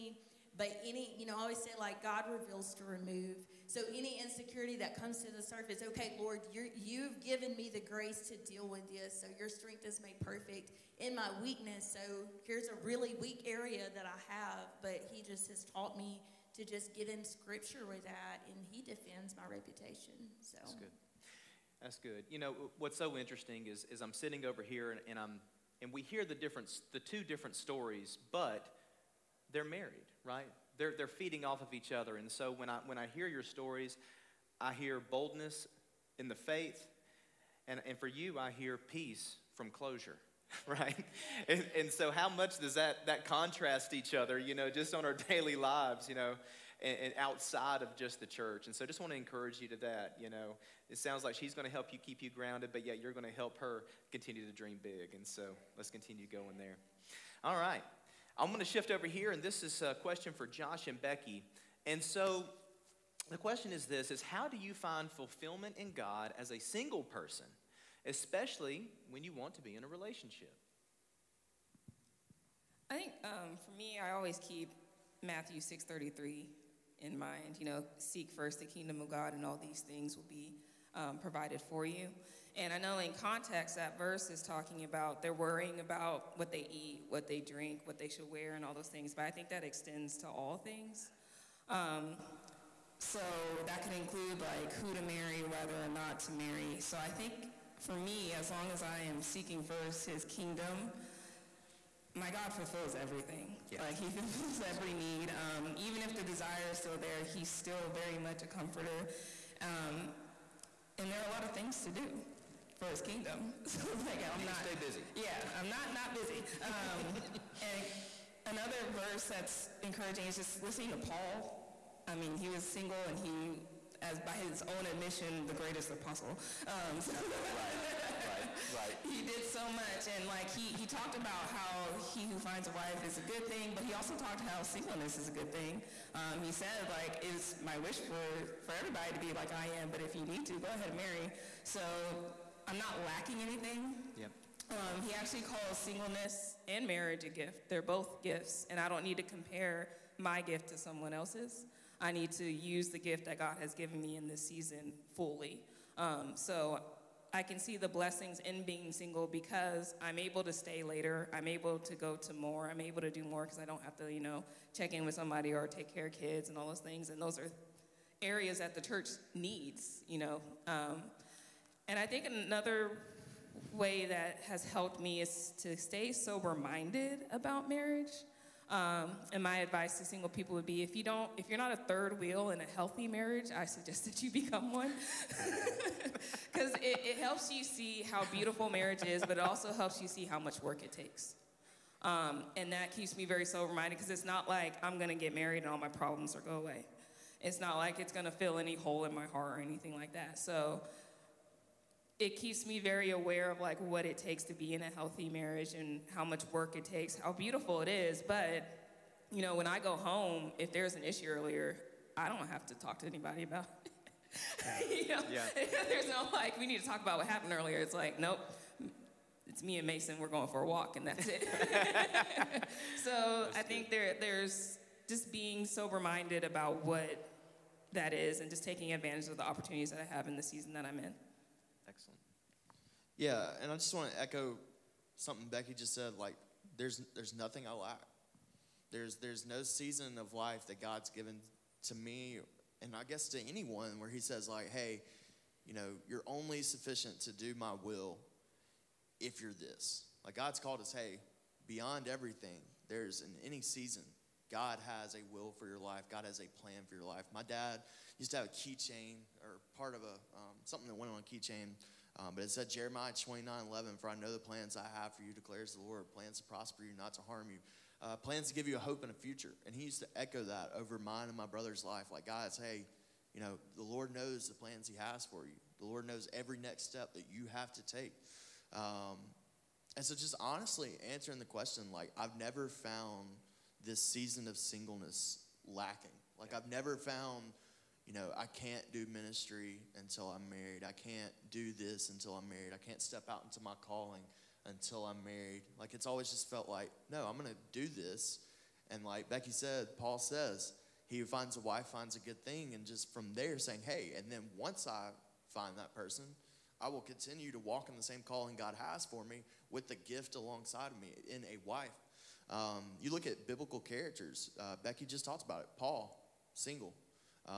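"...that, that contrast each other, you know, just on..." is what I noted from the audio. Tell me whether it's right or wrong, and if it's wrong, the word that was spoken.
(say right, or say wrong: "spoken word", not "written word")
right.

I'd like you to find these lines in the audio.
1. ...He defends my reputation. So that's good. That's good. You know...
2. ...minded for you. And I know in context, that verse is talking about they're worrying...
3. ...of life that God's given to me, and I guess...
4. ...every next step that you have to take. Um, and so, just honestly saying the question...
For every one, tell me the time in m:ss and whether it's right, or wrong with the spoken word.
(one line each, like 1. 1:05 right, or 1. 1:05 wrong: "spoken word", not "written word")
1. 0:18 right
2. 1:21 wrong: "provided", not "minded"
3. 4:00 right
4. 4:36 wrong: "answering", not "saying".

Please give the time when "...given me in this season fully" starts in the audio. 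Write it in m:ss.
2:33.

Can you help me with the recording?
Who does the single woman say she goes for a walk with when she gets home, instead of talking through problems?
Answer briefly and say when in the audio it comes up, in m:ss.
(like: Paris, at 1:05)
Mason, at 3:39.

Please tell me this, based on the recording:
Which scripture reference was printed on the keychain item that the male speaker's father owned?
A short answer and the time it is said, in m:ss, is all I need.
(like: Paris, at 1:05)
Jeremiah 29:11, at 4:22.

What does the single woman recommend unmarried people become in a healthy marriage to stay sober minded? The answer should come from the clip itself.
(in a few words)
a third wheel.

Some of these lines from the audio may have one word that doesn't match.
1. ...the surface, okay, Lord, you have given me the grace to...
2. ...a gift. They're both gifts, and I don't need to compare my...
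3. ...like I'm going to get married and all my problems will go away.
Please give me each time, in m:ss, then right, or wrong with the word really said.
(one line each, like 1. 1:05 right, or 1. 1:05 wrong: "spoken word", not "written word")
1. 0:05 right
2. 2:27 right
3. 3:14 right.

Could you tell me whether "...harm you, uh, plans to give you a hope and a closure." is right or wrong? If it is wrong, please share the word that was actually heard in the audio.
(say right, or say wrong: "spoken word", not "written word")
wrong: "future", not "closure".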